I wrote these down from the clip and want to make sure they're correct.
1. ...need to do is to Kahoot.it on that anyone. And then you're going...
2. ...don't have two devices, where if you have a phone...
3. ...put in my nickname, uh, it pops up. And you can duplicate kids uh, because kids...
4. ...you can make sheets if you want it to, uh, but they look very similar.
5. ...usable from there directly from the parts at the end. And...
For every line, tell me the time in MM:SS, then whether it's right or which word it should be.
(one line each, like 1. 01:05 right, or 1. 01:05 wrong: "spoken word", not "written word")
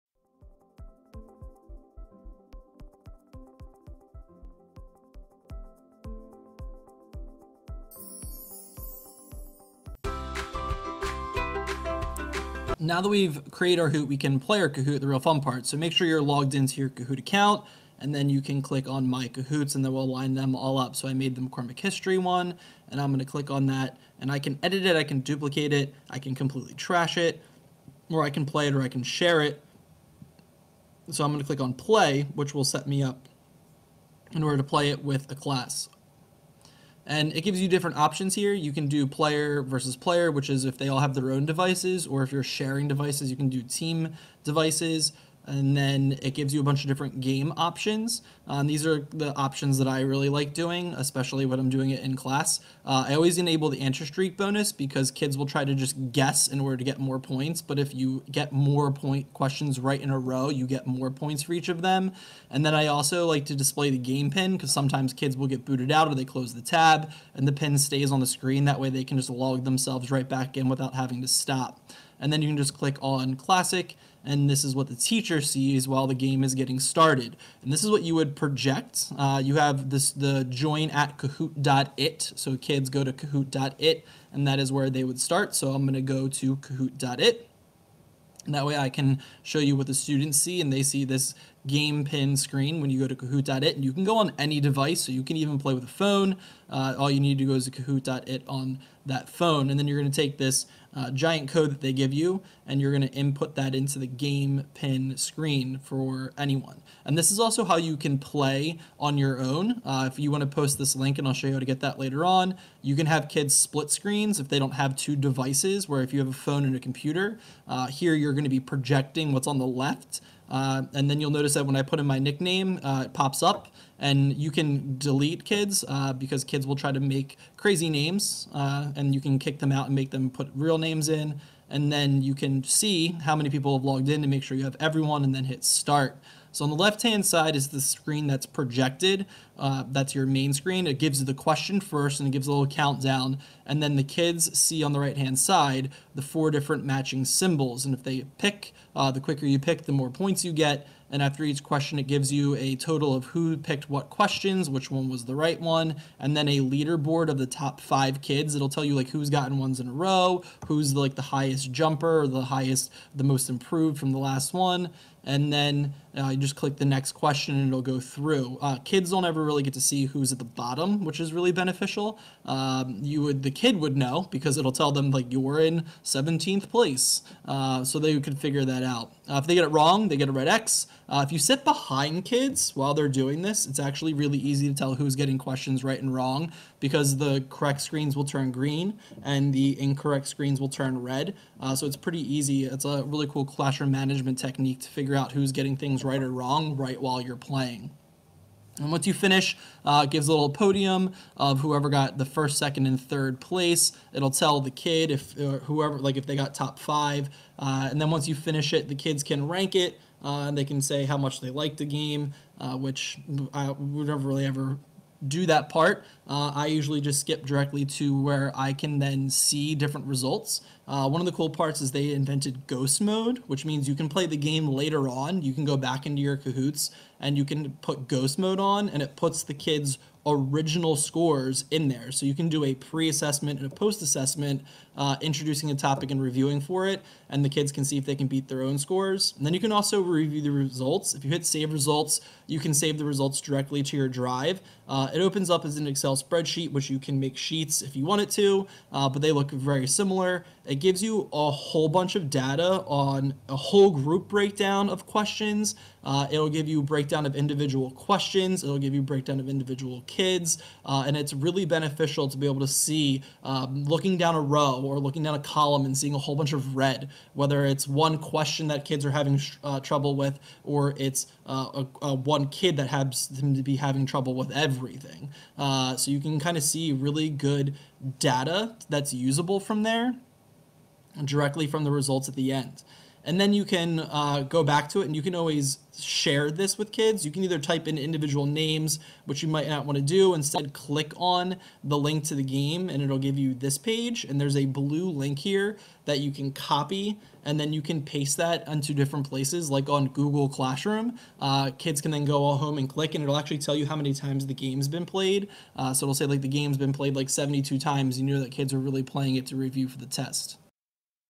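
1. 01:37 wrong: "phone", not "anyone"
2. 01:54 right
3. 02:01 wrong: "delete", not "duplicate"
4. 04:06 right
5. 04:39 wrong: "results", not "parts".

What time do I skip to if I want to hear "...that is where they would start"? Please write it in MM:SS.
01:24.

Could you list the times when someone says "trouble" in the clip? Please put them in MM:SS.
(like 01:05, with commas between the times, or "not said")
04:29, 04:34.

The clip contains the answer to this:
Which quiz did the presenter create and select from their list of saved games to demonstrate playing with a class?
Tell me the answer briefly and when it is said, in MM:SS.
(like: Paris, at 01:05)
McCormick History, at 00:21.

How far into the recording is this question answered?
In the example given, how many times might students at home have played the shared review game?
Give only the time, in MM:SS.
05:07.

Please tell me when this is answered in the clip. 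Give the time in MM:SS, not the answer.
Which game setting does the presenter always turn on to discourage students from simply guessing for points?
00:53.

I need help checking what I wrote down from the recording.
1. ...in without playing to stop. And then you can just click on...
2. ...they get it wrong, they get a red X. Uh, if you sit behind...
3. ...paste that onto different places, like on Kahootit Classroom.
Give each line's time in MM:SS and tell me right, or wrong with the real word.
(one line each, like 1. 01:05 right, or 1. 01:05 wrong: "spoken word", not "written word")
1. 01:10 wrong: "having", not "playing"
2. 02:59 right
3. 04:58 wrong: "Google", not "Kahootit".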